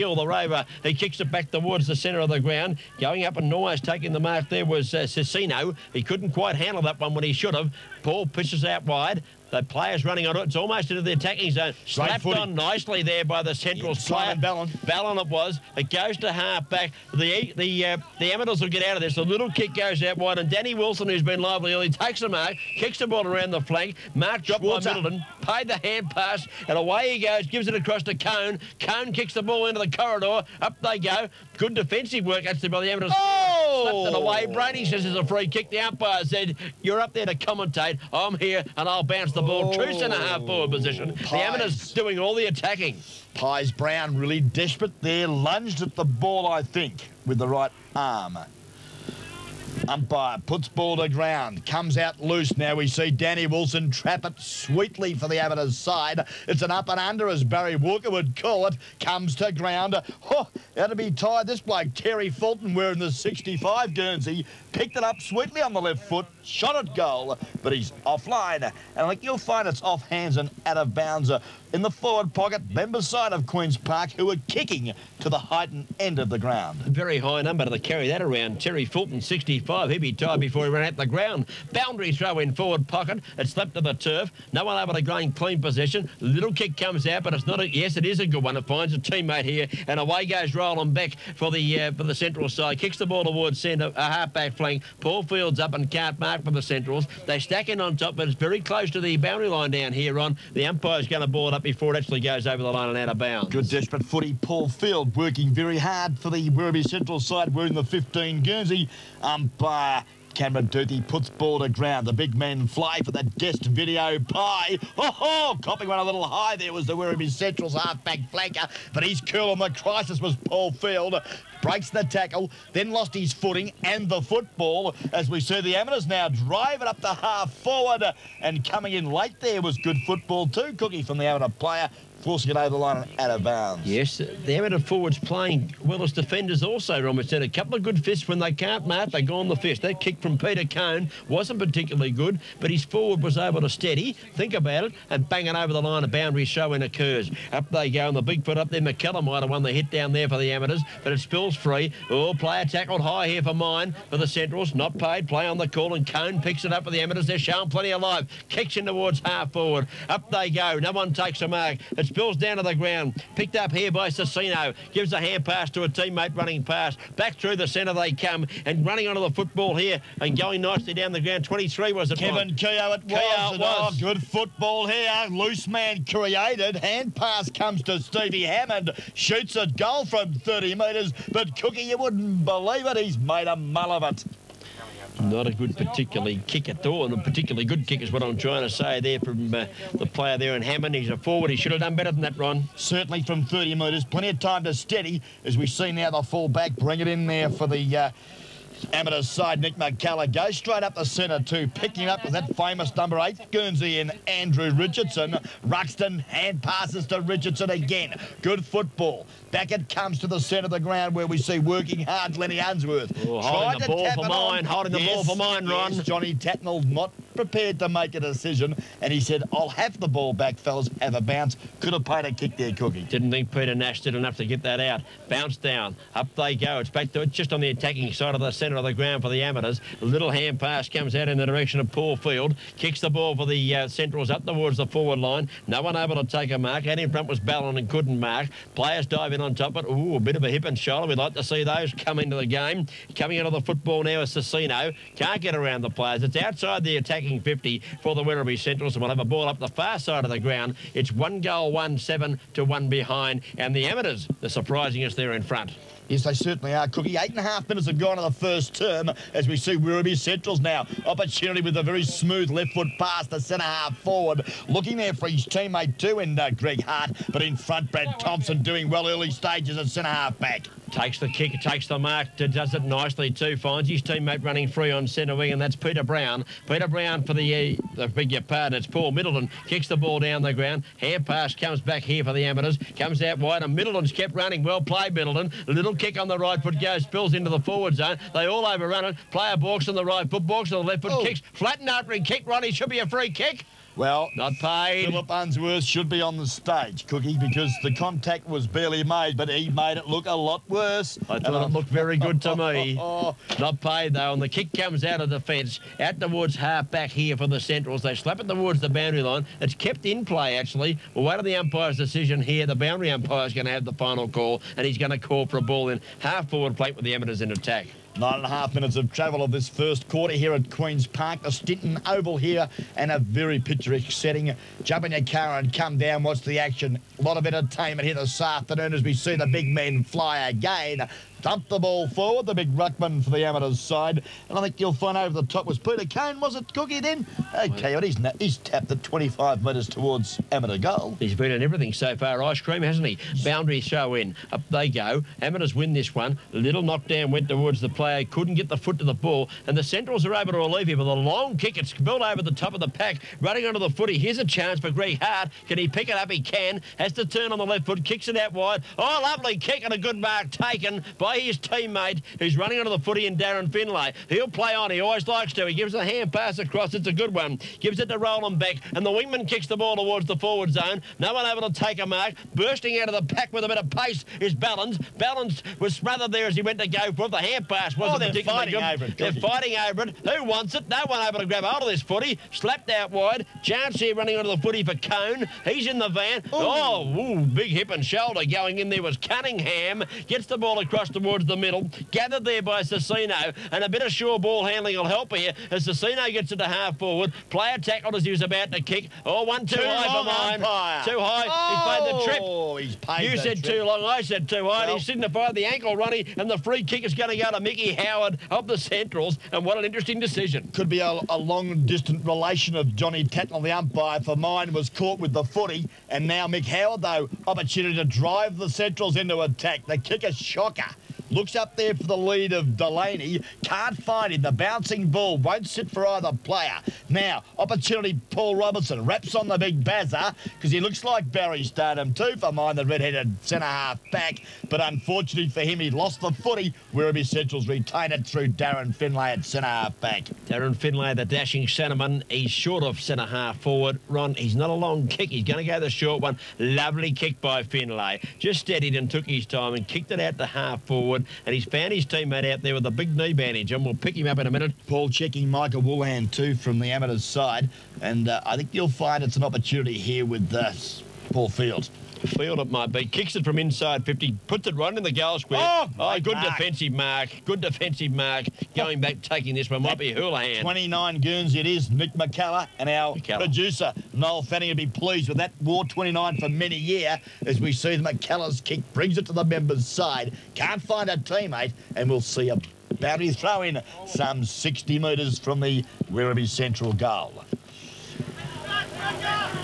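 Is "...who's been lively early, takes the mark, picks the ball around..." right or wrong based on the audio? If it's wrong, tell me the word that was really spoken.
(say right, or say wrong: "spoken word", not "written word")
wrong: "kicks", not "picks".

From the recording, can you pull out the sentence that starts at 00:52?
Now we see Danny Wilson trap it sweetly for the Amateurs side.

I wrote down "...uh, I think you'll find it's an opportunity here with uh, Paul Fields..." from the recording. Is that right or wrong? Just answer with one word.
right.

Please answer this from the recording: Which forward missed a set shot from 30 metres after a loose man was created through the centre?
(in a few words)
Stevie Hammond.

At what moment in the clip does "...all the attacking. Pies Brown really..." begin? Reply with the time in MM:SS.
00:42.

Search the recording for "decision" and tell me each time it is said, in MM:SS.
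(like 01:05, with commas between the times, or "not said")
03:38, 05:11, 06:50.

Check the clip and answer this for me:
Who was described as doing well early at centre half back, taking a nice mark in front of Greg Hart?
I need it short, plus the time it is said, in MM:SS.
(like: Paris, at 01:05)
Brad Thompson, at 04:27.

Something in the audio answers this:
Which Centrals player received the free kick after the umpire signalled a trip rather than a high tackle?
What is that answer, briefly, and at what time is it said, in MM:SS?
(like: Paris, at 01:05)
Mickey Howard, at 06:47.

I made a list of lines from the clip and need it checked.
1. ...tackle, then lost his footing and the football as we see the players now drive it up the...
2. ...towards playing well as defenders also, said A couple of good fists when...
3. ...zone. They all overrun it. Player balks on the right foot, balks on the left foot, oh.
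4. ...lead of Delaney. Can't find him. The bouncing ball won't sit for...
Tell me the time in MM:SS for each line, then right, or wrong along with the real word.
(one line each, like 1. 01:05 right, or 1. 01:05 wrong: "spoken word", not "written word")
1. 02:02 wrong: "amateurs", not "players"
2. 02:14 wrong: "forwards", not "towards"
3. 04:47 right
4. 07:02 right.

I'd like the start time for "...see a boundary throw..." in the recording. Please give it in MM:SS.
08:02.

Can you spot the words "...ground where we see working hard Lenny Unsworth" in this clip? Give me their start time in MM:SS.
03:30.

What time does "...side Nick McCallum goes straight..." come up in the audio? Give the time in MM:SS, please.
03:19.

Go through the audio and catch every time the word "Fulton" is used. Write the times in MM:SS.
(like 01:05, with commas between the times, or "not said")
01:02, 01:18.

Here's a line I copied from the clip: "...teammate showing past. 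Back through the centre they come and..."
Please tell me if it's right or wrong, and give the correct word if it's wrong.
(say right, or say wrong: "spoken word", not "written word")
wrong: "running", not "showing".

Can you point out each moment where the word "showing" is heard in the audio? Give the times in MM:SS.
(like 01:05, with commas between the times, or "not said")
02:26, 02:37.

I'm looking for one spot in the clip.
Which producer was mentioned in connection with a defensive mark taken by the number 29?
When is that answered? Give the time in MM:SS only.
07:54.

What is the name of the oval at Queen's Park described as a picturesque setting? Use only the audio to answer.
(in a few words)
Stinton Oval.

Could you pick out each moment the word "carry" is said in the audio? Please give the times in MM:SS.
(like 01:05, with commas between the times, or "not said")
01:17.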